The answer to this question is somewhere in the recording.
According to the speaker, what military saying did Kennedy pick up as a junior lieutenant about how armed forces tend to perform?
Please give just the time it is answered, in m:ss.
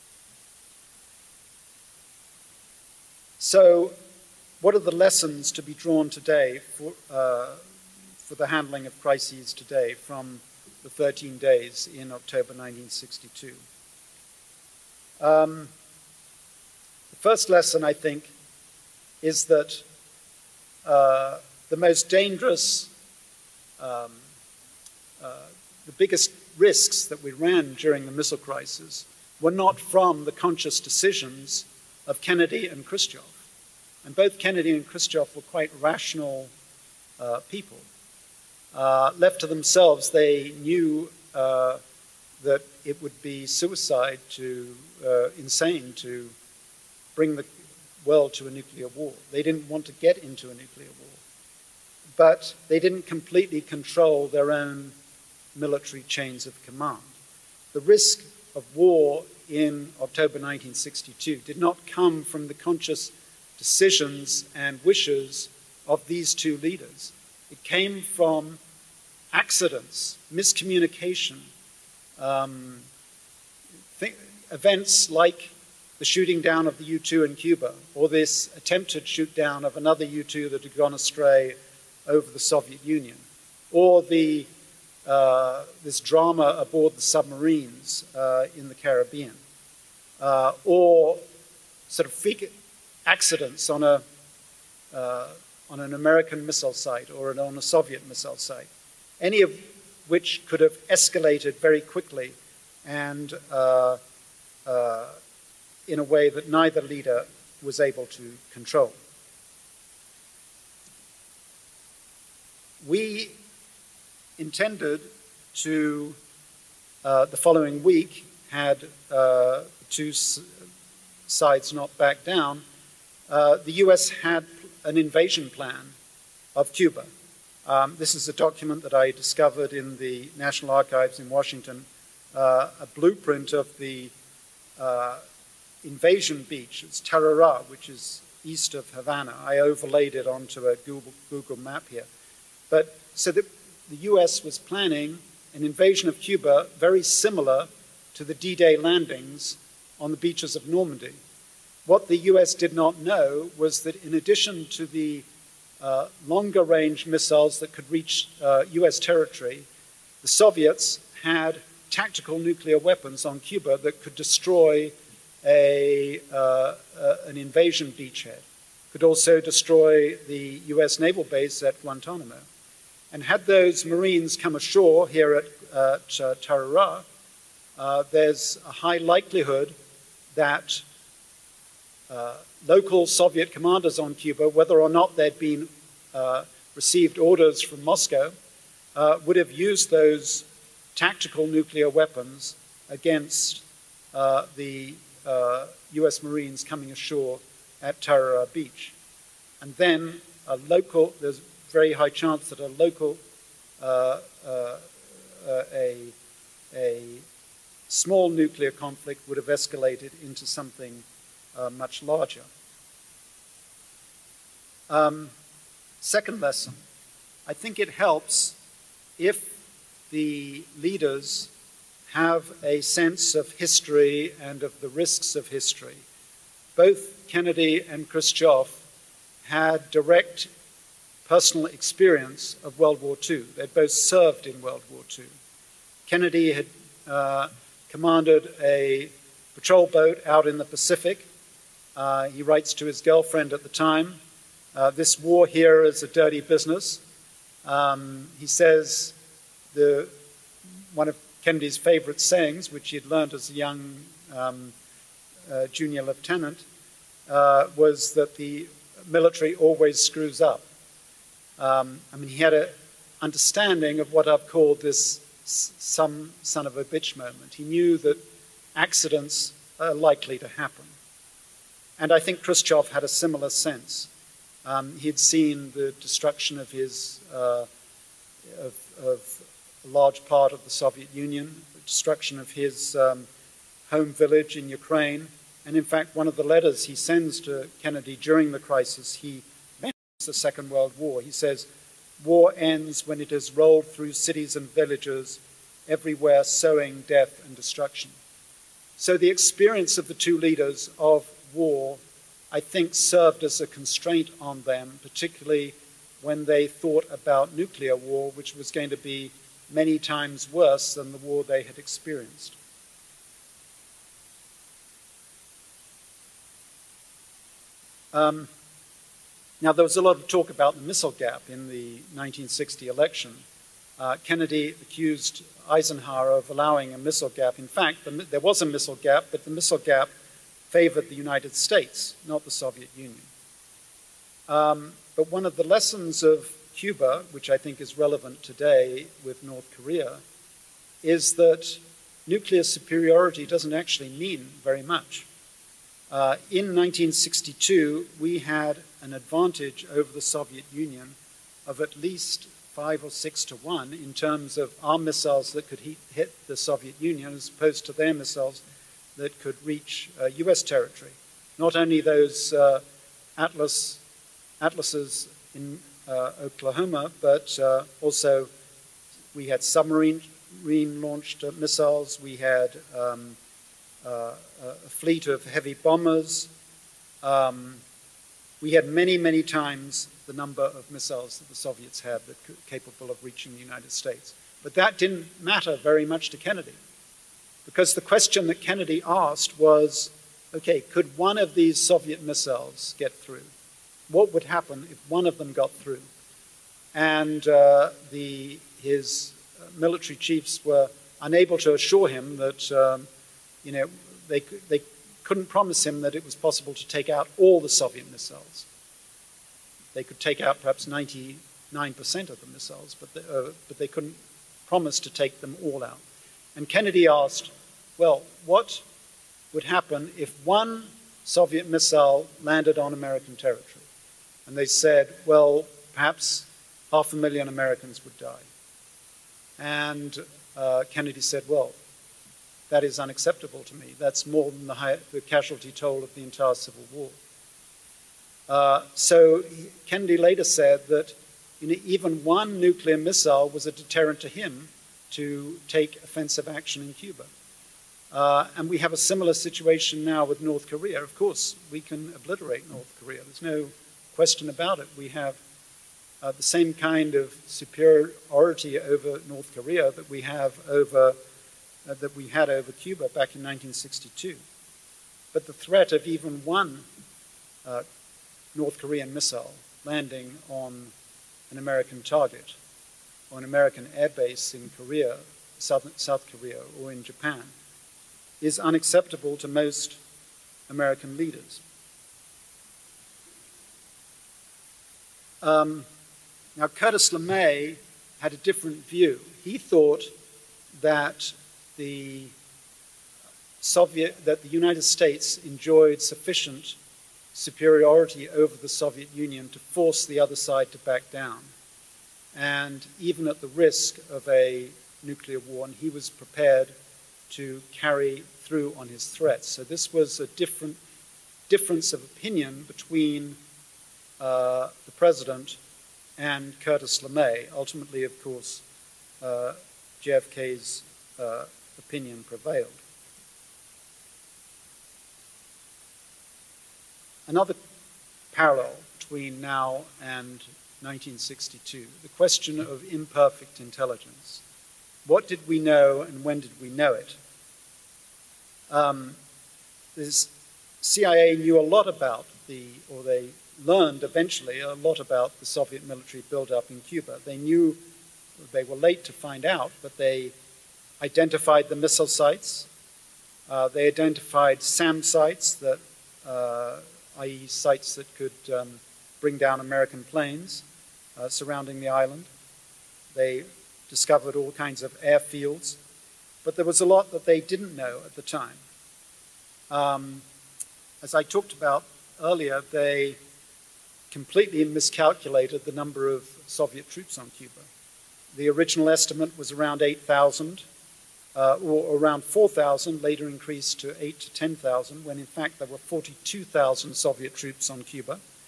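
4:18.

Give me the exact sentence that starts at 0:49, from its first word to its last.
They didn't want to get into a nuclear war but they didn't completely control their own military chains of command.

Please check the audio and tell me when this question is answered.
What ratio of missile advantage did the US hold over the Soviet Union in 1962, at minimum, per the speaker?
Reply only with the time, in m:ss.
5:52.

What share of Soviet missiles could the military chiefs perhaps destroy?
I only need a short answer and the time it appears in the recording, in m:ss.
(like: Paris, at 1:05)
99%, at 6:50.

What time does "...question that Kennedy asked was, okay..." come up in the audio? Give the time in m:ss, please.
6:28.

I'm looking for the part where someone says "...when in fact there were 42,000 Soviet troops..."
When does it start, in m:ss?
9:45.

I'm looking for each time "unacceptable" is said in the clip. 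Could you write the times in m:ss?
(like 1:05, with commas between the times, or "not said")
7:12, 7:58.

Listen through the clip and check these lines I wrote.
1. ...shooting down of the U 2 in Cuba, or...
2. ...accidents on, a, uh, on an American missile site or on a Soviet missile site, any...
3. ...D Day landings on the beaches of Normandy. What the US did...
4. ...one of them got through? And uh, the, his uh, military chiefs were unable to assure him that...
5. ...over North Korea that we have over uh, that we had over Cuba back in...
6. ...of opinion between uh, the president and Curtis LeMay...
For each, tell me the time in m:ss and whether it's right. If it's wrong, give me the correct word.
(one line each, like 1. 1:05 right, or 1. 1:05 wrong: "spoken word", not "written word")
1. 1:16 right
2. 1:33 right
3. 2:28 right
4. 6:35 right
5. 7:38 right
6. 8:31 right.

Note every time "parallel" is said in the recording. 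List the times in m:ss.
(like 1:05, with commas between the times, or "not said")
8:48.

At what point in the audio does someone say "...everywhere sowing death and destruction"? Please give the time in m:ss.
4:55.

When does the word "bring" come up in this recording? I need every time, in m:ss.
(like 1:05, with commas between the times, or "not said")
0:47, 9:19.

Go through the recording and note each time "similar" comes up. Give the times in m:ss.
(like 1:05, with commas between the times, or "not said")
2:27, 4:33, 7:28.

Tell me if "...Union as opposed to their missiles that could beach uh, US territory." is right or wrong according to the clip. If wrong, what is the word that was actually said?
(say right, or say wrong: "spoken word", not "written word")
wrong: "reach", not "beach".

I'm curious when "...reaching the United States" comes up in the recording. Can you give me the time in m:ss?
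6:23.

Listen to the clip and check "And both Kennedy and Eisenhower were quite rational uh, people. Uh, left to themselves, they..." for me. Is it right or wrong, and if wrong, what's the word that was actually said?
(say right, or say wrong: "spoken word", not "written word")
wrong: "Khrushchev", not "Eisenhower".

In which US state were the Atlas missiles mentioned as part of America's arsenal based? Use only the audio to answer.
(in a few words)
Oklahoma.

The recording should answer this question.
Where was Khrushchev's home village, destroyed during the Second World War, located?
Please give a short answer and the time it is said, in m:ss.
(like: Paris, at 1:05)
Ukraine, at 4:44.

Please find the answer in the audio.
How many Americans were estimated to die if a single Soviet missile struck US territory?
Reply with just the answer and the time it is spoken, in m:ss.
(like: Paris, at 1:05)
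half a million, at 7:06.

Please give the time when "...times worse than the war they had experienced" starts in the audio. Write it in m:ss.
5:09.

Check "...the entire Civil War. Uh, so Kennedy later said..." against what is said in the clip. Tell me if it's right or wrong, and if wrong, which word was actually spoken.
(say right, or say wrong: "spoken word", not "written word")
right.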